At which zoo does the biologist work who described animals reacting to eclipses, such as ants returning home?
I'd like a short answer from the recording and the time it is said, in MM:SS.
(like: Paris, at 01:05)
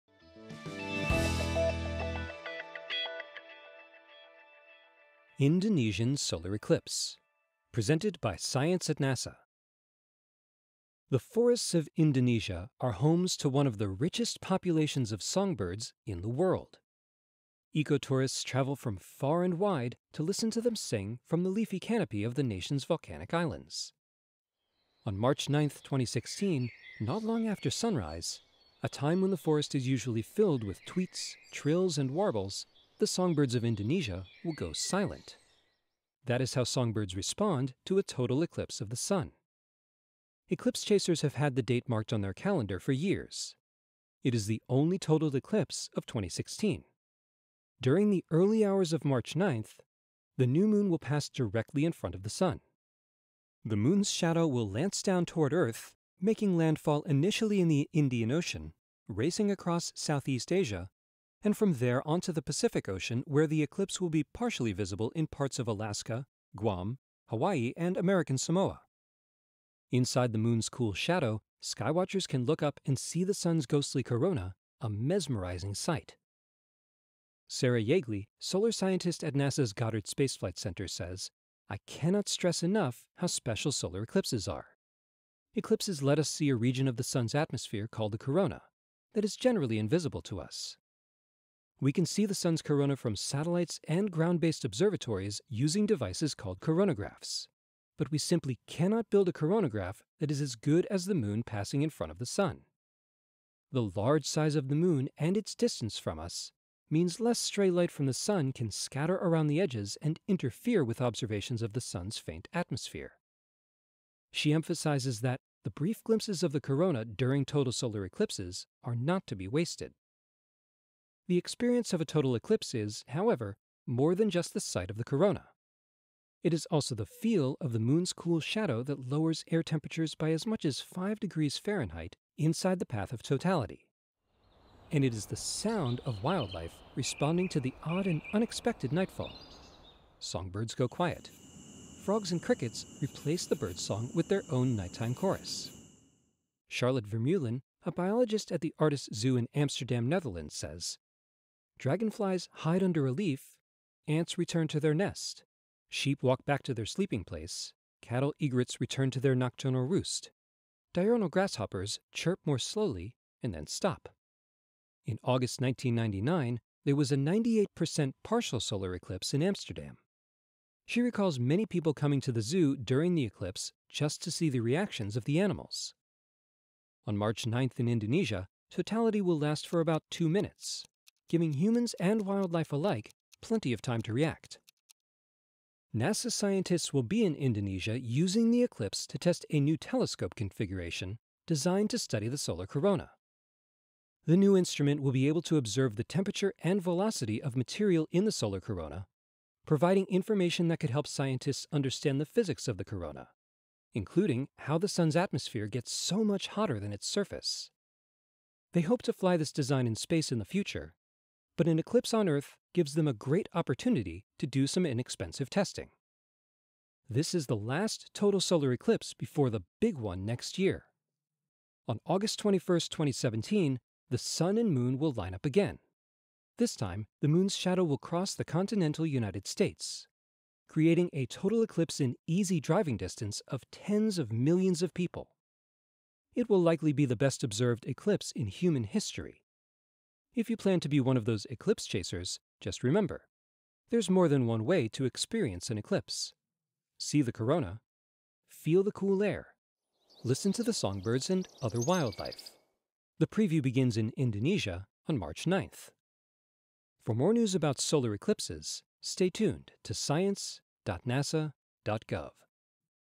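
Artis Zoo, at 02:28.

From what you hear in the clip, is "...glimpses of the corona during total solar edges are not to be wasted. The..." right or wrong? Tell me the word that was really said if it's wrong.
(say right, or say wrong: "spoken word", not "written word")
wrong: "eclipses", not "edges".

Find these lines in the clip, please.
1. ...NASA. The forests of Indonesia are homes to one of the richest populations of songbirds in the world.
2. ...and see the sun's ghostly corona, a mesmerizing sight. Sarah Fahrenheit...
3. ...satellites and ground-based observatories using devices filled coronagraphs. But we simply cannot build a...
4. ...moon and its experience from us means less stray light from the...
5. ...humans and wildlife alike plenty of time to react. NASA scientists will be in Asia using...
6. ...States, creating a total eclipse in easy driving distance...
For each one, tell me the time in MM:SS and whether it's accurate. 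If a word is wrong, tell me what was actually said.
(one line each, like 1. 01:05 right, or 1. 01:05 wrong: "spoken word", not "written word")
1. 00:08 right
2. 01:12 wrong: "Jaeggli", not "Fahrenheit"
3. 01:33 wrong: "called", not "filled"
4. 01:44 wrong: "distance", not "experience"
5. 03:01 wrong: "Indonesia", not "Asia"
6. 03:49 right.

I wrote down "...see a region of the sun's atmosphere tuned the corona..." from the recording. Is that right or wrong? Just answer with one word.
wrong.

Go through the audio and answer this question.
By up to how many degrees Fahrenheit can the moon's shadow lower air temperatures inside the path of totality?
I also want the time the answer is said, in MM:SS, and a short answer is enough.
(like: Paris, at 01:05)
5 degrees, at 02:10.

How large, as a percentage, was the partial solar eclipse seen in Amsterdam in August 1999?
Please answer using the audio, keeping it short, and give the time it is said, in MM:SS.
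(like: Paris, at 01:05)
98%, at 02:47.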